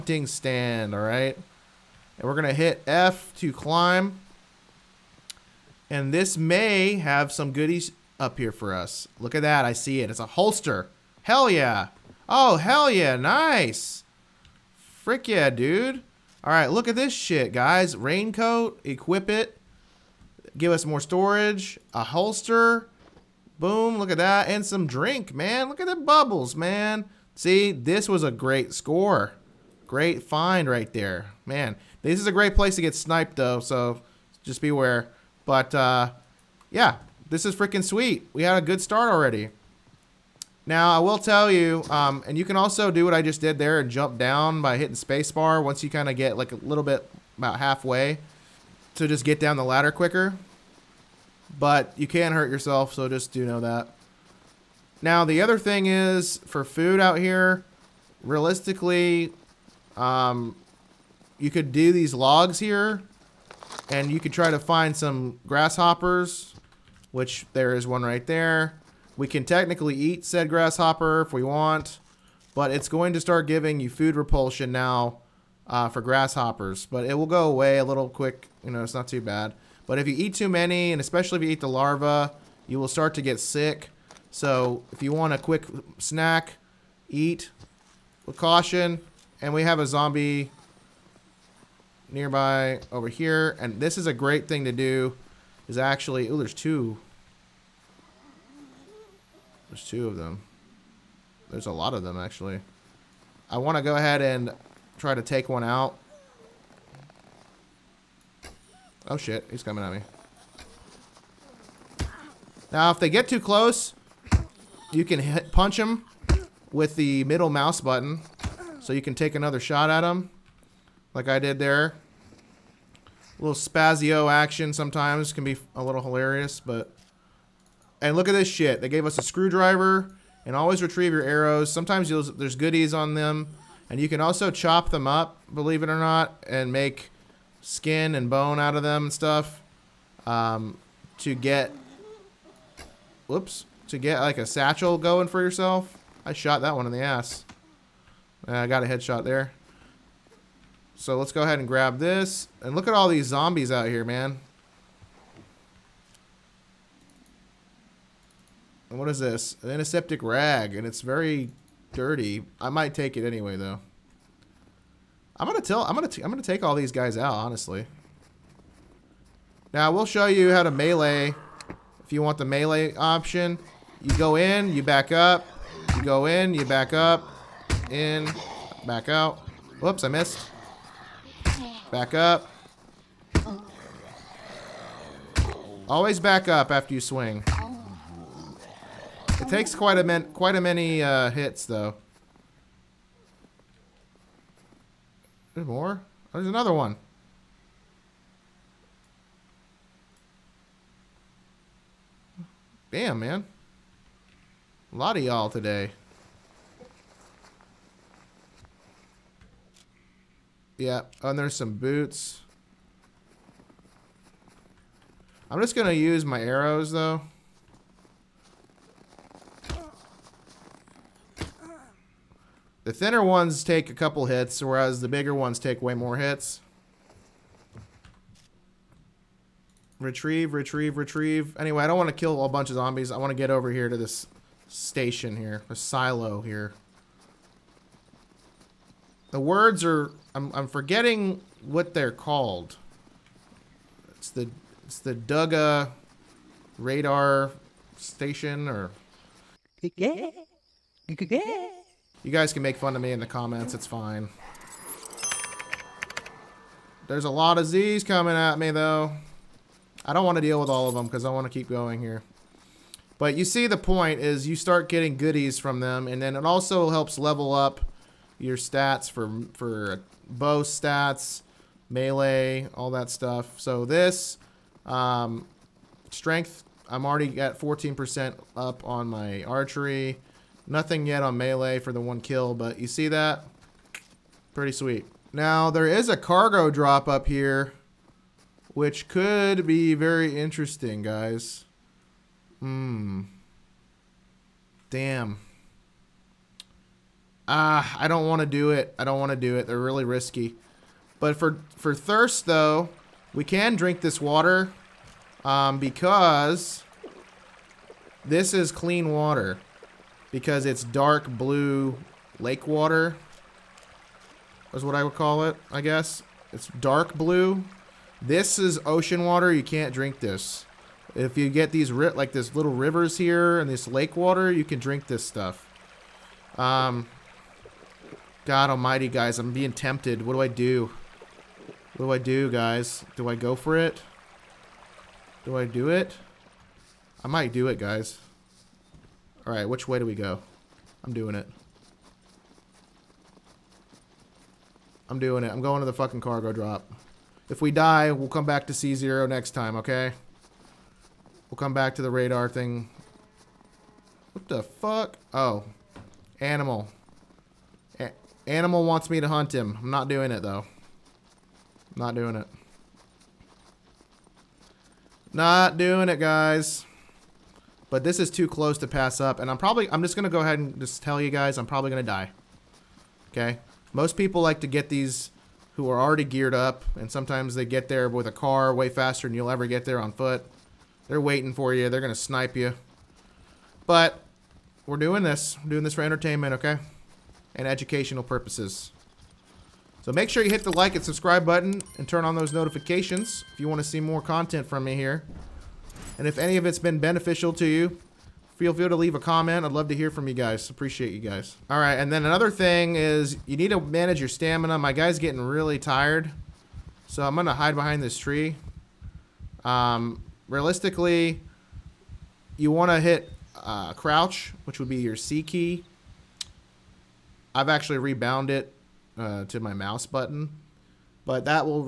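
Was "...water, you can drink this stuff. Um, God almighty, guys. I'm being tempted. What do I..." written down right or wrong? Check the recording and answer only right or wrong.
right.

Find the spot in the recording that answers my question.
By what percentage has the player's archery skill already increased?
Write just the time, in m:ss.
4:37.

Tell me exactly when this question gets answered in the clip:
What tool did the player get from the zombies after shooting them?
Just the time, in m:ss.
2:09.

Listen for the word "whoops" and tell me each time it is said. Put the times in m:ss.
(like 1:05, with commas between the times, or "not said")
2:23, 2:59.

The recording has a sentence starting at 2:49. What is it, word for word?
Now we'll show you how to melee.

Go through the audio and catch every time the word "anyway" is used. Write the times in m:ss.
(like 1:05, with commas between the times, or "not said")
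2:43, 3:51.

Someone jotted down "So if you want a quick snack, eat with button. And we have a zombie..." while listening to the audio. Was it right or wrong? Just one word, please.
wrong.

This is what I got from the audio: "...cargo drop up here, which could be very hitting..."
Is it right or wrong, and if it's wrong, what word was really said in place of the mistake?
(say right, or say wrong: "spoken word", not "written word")
wrong: "interesting", not "hitting".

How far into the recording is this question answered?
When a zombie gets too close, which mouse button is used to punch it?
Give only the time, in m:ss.
1:57.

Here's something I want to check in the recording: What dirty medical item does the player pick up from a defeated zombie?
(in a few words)
Antiseptic rag.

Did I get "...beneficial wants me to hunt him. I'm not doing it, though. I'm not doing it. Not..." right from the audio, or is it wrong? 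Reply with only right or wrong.
wrong.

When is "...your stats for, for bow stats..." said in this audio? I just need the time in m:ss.
4:28.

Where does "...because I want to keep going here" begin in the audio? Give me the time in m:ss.
4:21.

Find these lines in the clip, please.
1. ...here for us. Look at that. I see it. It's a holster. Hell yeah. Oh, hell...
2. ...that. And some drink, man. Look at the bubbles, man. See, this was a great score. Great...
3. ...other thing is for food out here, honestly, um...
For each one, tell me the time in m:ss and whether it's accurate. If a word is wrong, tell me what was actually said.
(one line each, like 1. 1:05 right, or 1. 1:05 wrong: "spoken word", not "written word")
1. 0:08 right
2. 0:24 right
3. 0:55 wrong: "realistically", not "honestly".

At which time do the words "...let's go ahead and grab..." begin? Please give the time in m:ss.
2:31.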